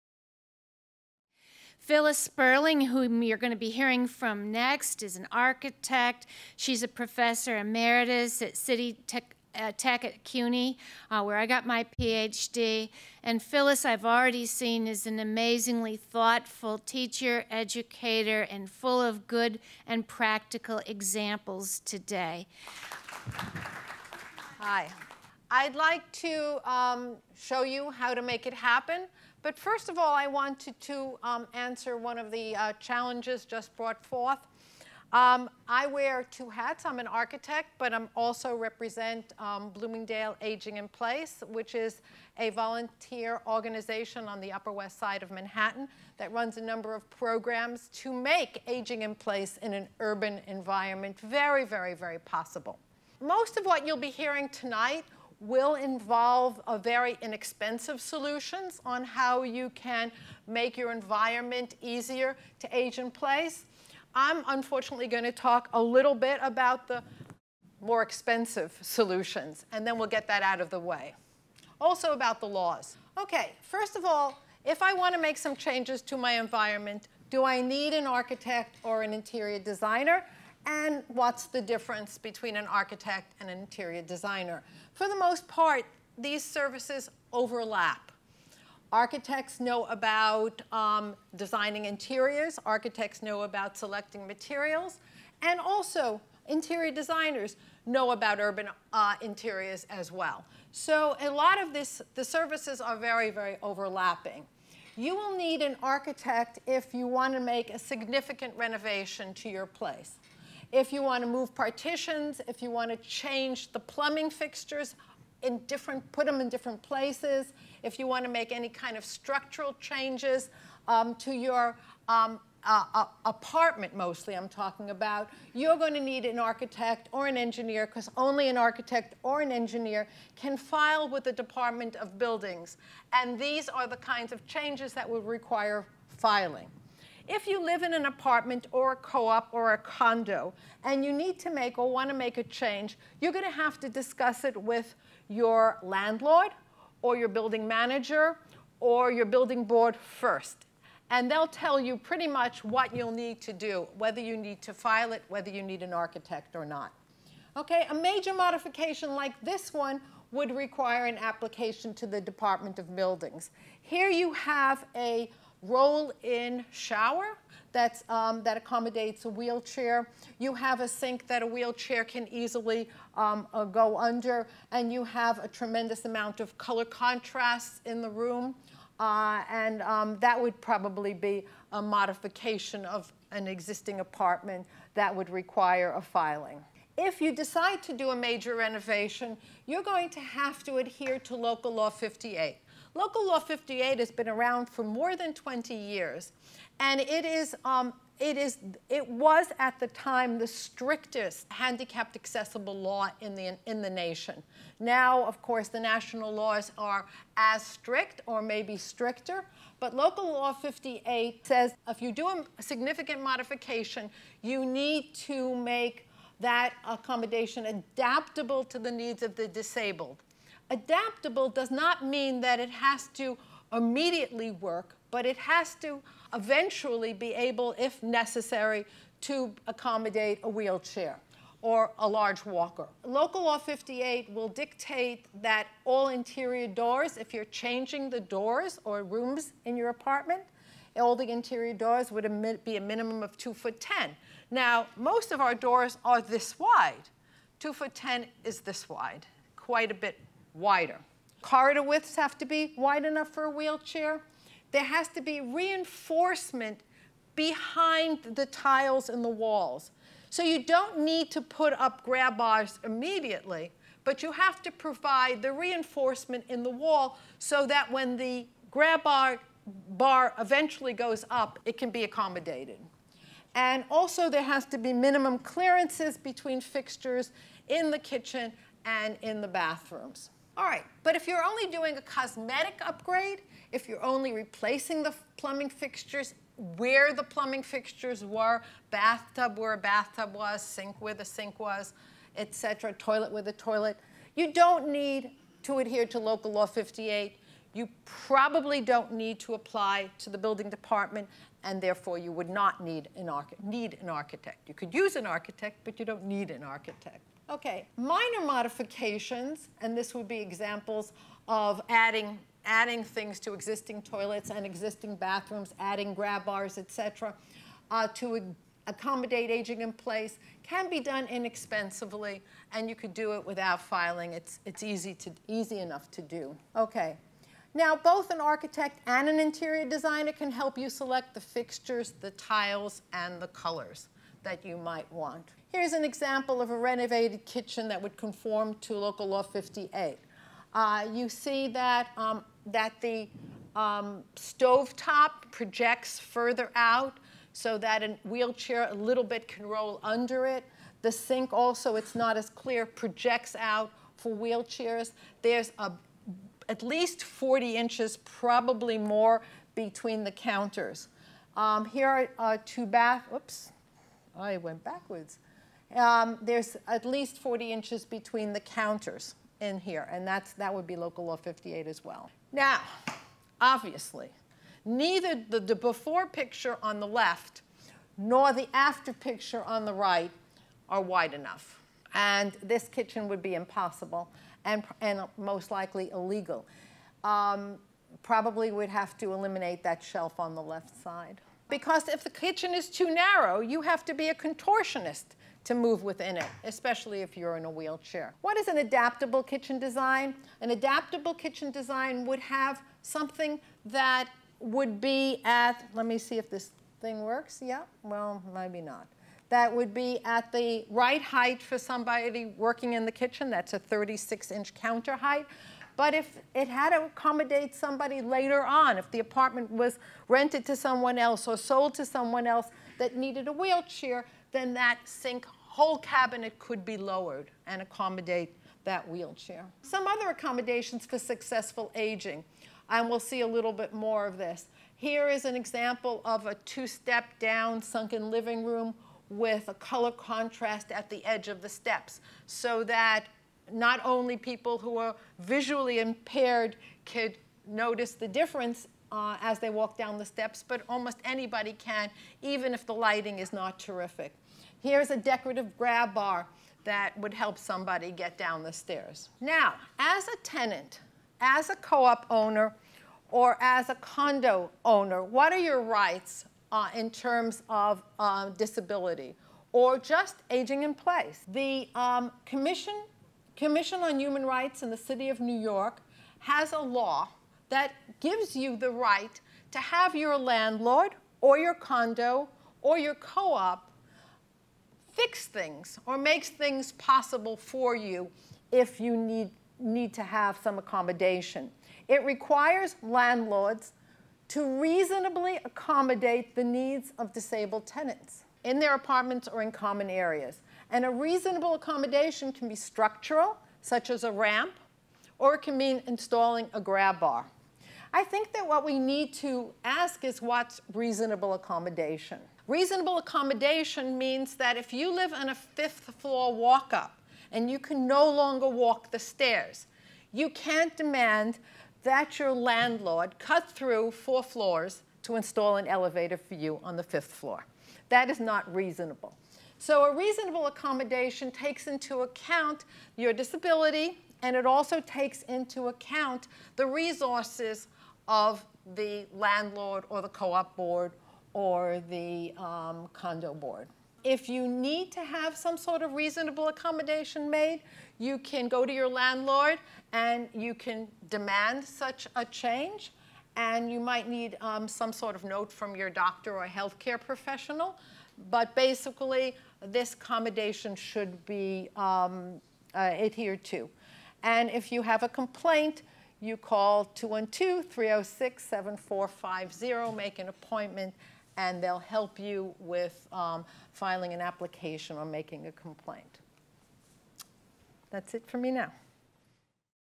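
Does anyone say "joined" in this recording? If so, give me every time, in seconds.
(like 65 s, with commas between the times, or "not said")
not said.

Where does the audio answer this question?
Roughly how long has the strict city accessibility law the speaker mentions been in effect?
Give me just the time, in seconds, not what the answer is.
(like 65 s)
194 s.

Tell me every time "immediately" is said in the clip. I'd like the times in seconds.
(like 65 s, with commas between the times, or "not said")
223 s, 262 s.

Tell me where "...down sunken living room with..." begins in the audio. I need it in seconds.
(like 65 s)
437 s.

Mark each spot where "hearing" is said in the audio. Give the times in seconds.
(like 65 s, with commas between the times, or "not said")
3 s, 54 s.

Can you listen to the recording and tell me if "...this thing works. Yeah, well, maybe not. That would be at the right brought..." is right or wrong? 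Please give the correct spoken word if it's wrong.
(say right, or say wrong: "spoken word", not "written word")
wrong: "height", not "brought".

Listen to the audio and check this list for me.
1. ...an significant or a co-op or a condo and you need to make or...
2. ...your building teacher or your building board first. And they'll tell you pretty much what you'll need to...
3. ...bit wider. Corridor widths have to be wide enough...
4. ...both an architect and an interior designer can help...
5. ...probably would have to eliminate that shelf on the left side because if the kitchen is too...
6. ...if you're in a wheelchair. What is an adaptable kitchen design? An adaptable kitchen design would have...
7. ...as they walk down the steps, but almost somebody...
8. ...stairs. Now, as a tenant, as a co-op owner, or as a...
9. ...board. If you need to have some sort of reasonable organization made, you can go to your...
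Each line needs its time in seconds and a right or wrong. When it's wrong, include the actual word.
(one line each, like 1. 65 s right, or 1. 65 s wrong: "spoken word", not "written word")
1. 137 s wrong: "apartment", not "significant"
2. 147 s wrong: "manager", not "teacher"
3. 249 s right
4. 327 s right
5. 388 s right
6. 397 s right
7. 449 s wrong: "anybody", not "somebody"
8. 458 s right
9. 543 s wrong: "accommodation", not "organization".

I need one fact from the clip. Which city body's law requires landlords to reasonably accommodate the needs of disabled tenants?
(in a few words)
Commission on Human Rights.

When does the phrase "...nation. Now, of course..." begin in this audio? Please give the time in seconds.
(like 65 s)
203 s.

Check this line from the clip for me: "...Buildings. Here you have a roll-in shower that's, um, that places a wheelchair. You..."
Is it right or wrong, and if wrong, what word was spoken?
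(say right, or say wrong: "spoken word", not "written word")
wrong: "accommodates", not "places".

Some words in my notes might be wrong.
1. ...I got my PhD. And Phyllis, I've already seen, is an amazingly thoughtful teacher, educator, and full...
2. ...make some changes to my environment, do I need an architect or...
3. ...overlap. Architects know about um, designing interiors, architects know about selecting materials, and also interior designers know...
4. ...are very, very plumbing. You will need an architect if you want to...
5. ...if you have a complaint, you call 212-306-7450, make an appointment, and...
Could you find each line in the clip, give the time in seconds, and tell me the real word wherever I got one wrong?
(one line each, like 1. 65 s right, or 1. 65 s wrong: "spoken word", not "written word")
1. 11 s right
2. 75 s right
3. 87 s right
4. 102 s wrong: "overlapping", not "plumbing"
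5. 564 s right.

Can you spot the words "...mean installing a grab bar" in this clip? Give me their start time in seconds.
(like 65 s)
505 s.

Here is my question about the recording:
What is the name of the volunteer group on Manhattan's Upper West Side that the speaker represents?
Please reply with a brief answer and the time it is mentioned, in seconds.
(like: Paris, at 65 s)
Bloomingdale Aging in Place, at 39 s.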